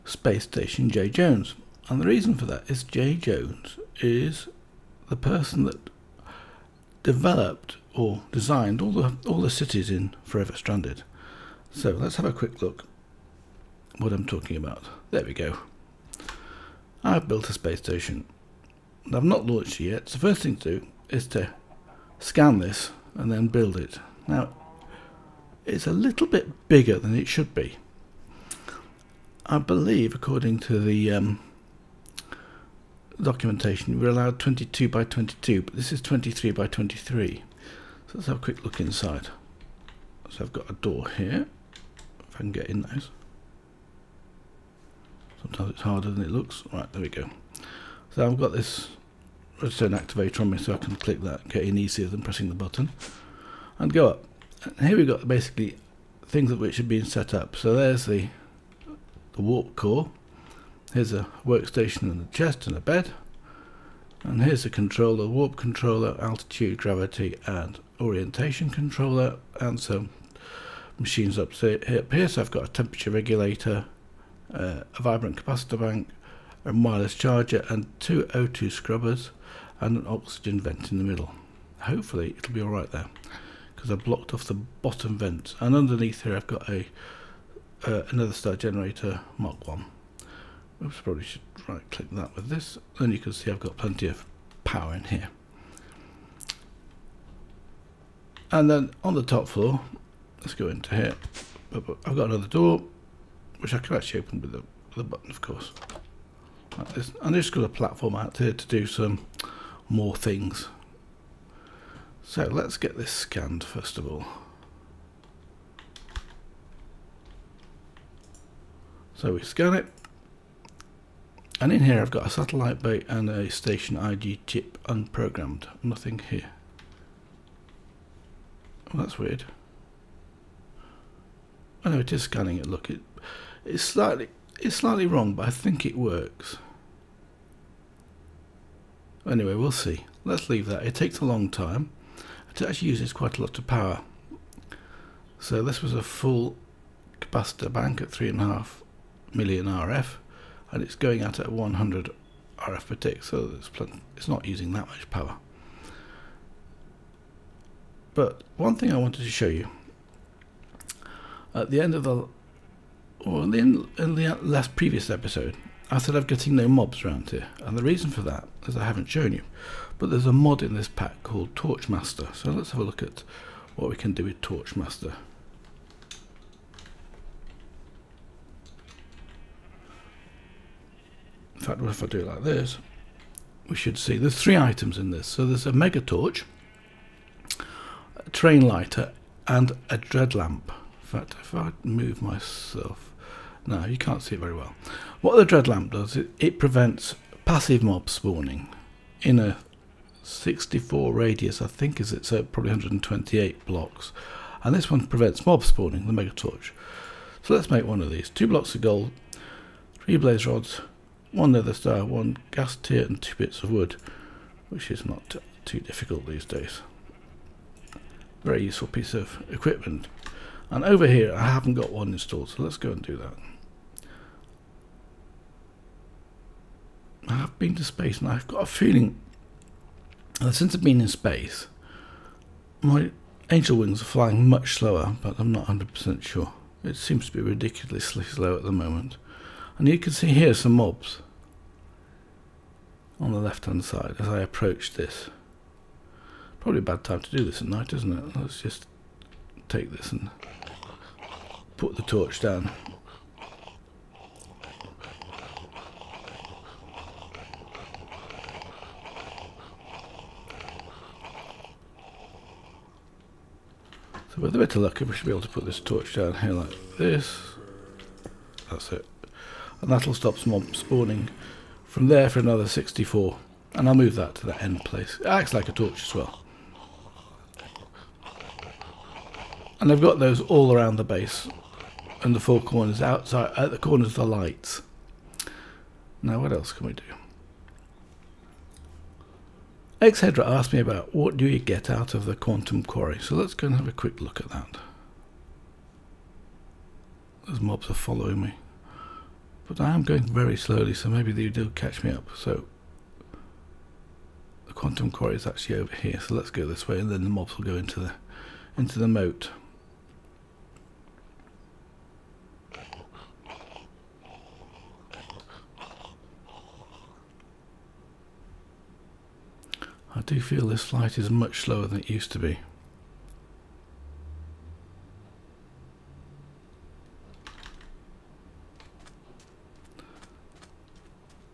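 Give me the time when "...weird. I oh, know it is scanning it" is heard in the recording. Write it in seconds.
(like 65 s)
129 s.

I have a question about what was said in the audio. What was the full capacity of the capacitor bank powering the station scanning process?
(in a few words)
3.5 million RF.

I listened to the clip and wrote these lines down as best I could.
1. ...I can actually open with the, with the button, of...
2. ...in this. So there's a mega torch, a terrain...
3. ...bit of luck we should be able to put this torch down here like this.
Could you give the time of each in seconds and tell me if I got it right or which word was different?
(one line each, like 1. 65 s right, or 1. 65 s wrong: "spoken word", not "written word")
1. 103 s right
2. 184 s right
3. 264 s right.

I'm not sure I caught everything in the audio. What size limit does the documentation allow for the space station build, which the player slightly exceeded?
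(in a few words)
22 by 22.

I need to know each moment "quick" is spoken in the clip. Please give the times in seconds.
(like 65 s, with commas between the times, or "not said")
12 s, 38 s, 293 s.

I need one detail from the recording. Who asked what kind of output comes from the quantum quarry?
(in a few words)
Xhedra.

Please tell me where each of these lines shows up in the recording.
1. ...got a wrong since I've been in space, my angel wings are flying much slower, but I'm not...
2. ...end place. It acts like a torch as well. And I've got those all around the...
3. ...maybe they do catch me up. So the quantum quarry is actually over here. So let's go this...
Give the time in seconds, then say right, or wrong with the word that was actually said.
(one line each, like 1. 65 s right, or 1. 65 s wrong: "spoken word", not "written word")
1. 228 s wrong: "feeling", not "wrong"
2. 274 s right
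3. 301 s right.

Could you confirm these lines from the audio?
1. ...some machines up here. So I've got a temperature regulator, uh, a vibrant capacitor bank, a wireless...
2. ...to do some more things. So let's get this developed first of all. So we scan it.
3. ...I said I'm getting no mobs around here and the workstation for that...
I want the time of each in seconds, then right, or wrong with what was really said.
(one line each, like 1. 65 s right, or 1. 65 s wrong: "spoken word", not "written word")
1. 69 s right
2. 108 s wrong: "scanned", not "developed"
3. 165 s wrong: "reason", not "workstation".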